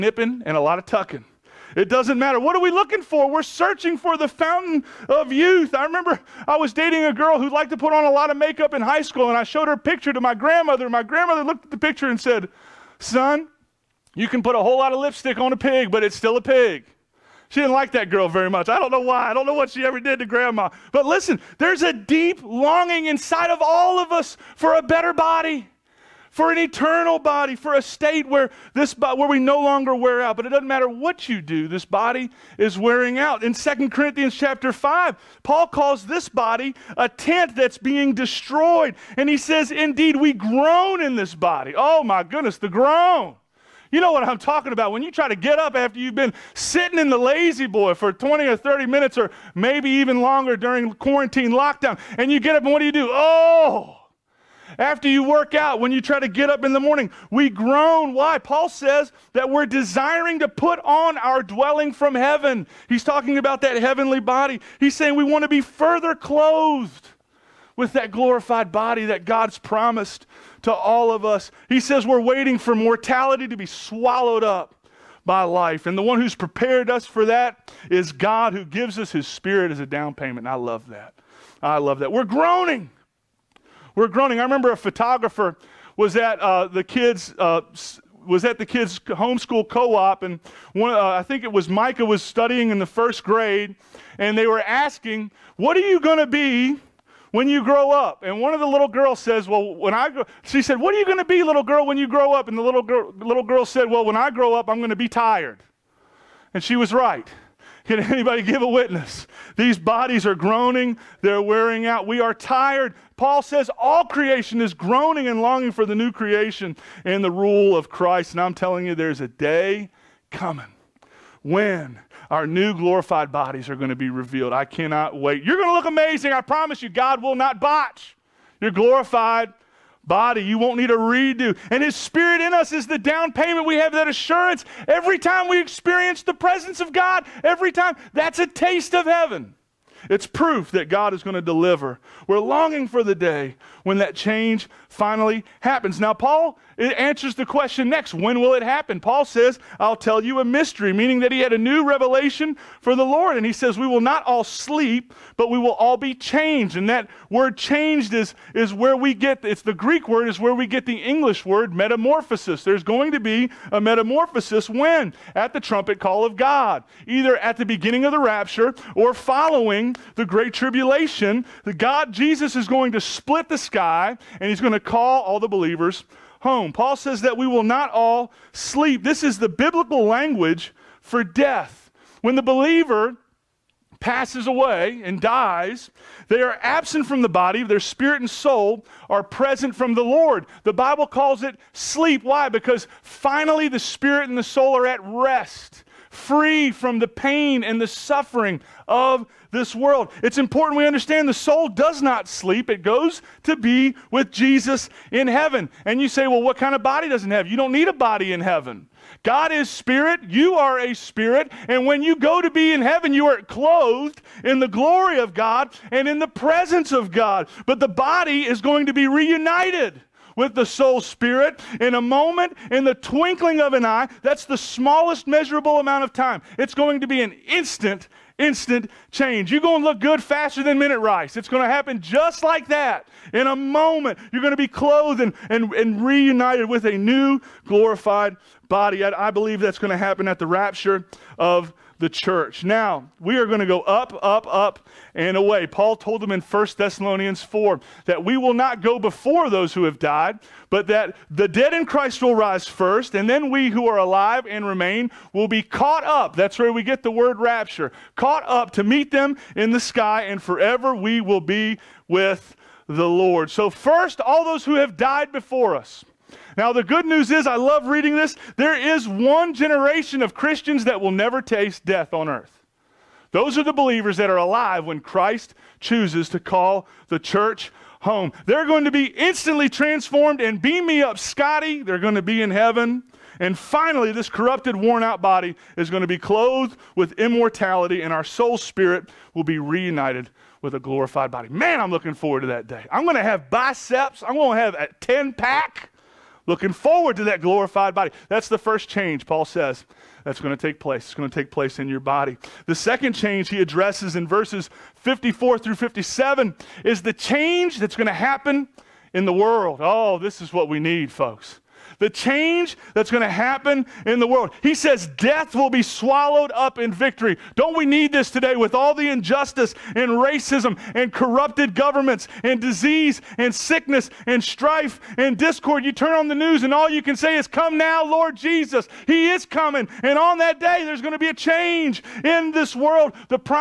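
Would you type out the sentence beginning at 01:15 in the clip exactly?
And the one who's prepared us for that is God who gives us his spirit as a down payment.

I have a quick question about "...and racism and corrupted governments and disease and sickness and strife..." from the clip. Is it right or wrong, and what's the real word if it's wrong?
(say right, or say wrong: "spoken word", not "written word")
right.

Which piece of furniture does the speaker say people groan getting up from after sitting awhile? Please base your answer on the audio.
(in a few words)
La-Z-Boy.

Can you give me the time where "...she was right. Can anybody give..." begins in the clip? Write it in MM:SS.
01:46.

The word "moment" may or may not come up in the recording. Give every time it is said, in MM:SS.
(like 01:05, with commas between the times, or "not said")
03:41, 03:53.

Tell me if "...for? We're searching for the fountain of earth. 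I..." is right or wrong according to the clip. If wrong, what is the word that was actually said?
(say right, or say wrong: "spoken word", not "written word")
wrong: "youth", not "earth".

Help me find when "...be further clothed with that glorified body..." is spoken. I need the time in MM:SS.
01:05.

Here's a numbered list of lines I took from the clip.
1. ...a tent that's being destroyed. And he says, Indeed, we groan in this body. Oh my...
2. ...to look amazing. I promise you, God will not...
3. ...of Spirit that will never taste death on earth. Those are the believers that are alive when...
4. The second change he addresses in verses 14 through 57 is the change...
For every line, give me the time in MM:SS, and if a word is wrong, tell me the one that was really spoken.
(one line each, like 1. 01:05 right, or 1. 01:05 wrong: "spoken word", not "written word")
1. 00:36 right
2. 02:05 right
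3. 04:30 wrong: "Christians", not "Spirit"
4. 05:02 wrong: "54", not "14".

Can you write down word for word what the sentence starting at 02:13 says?
We have that assurance every time we experience the presence of God, every time.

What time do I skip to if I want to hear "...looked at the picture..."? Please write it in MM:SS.
00:11.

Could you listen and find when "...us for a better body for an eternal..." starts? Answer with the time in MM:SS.
00:24.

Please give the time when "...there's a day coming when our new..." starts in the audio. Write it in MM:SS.
01:58.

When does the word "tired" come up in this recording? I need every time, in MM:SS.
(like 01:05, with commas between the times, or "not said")
01:45, 01:52.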